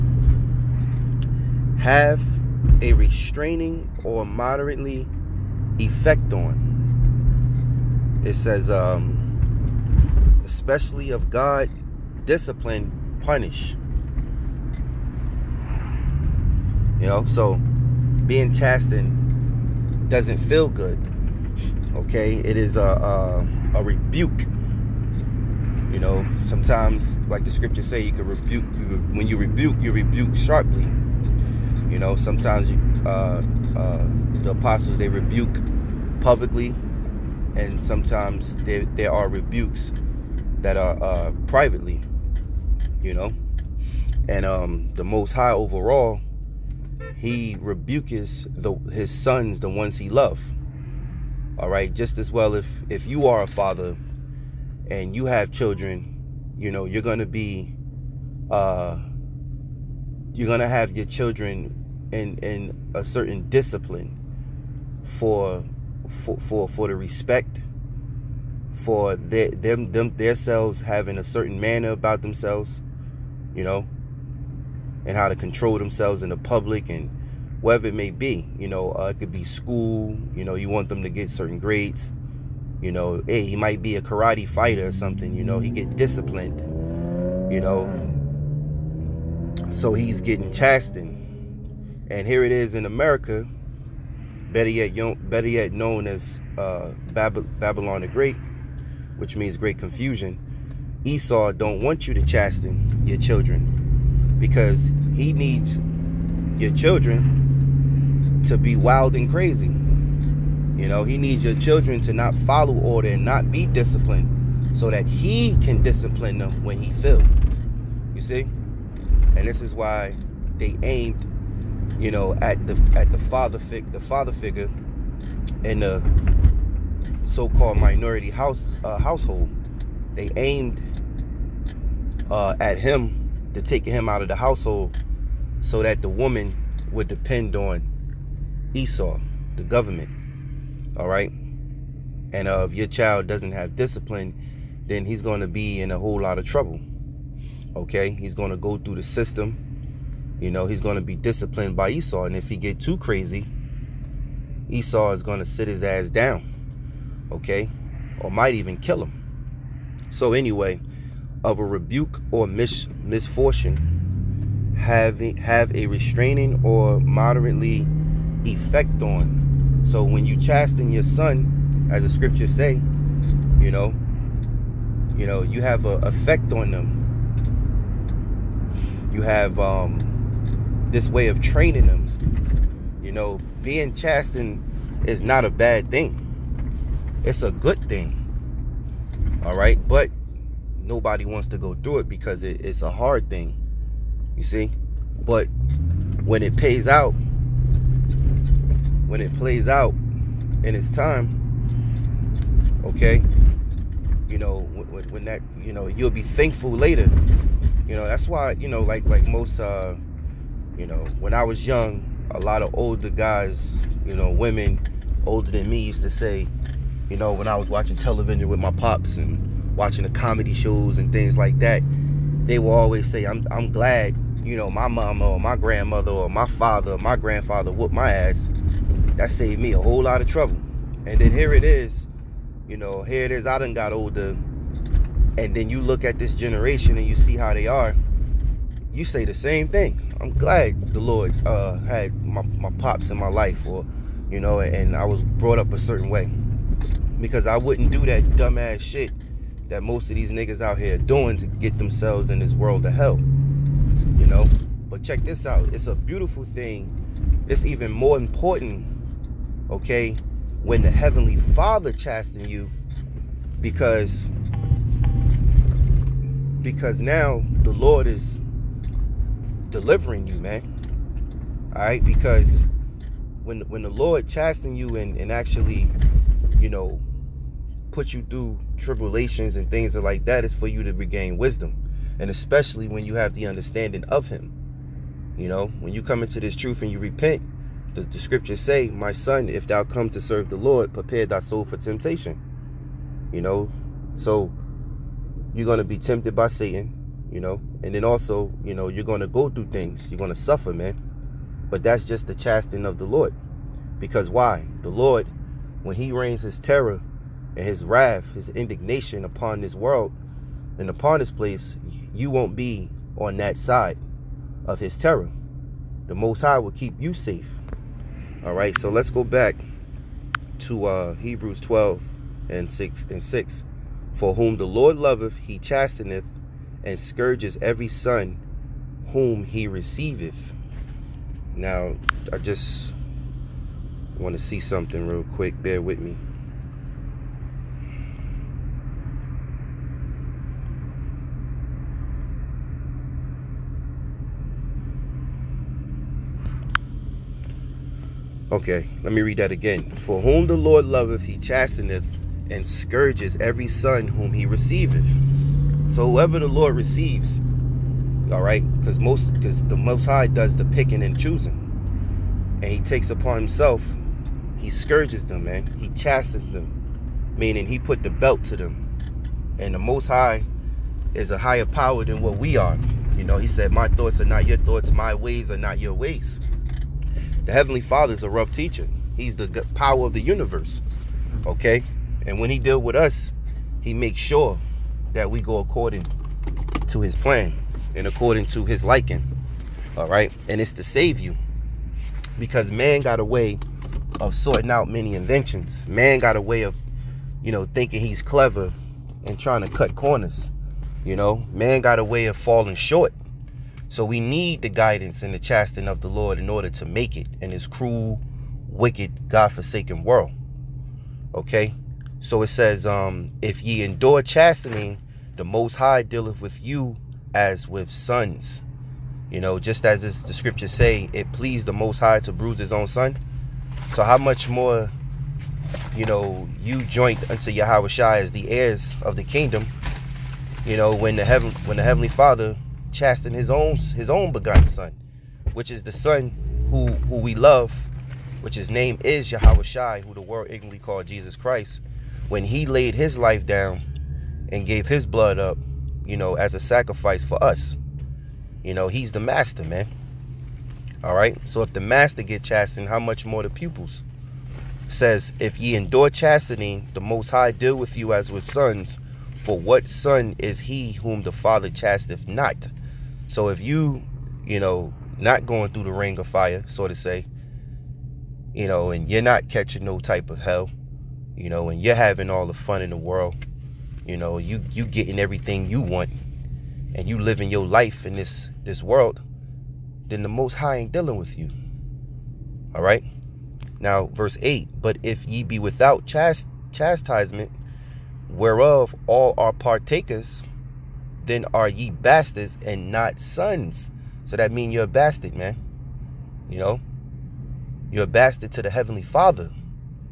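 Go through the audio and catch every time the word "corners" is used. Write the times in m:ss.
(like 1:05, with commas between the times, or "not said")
6:39.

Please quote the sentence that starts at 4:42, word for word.
And especially when you have the understanding of him.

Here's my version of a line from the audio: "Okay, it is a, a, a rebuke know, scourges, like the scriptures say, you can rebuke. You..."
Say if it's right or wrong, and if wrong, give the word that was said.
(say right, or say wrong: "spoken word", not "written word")
wrong: "sometimes", not "scourges".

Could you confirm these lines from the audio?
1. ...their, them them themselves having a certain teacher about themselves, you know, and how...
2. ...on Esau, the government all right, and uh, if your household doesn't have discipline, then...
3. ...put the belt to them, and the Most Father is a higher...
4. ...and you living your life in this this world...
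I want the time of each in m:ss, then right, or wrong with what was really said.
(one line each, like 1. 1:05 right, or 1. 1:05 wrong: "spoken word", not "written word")
1. 1:09 wrong: "manner", not "teacher"
2. 2:17 wrong: "child", not "household"
3. 6:07 wrong: "High", not "Father"
4. 7:56 right.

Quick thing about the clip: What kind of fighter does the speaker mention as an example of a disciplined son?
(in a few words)
Karate fighter.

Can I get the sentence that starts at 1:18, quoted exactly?
You know, uh, it could be school.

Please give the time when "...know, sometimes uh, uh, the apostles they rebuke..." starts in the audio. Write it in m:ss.
0:31.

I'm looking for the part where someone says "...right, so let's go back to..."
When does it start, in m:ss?
5:18.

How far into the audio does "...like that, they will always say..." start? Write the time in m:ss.
3:41.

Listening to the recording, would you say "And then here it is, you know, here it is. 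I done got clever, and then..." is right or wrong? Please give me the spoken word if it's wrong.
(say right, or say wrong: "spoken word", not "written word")
wrong: "older", not "clever".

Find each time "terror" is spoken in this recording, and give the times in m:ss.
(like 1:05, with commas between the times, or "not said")
5:06, 5:14.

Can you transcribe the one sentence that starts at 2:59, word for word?
You have um, this way of training them.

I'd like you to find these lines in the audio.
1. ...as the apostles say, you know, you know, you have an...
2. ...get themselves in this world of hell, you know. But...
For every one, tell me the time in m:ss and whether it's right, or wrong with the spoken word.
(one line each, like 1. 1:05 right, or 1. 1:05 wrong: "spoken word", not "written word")
1. 2:51 wrong: "scriptures", not "apostles"
2. 4:11 right.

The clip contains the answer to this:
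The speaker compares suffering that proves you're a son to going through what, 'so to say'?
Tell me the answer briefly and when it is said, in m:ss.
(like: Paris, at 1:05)
The ring of fire, at 7:45.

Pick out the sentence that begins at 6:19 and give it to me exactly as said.
He's the power of the universe.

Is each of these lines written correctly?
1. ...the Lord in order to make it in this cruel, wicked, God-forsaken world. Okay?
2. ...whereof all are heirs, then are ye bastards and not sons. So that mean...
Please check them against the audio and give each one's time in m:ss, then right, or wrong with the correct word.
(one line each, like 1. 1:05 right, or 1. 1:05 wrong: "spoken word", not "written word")
1. 6:46 right
2. 8:08 wrong: "partakers", not "heirs".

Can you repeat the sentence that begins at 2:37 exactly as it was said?
Okay, or might even kill him.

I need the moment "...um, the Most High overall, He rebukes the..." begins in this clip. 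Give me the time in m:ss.
0:44.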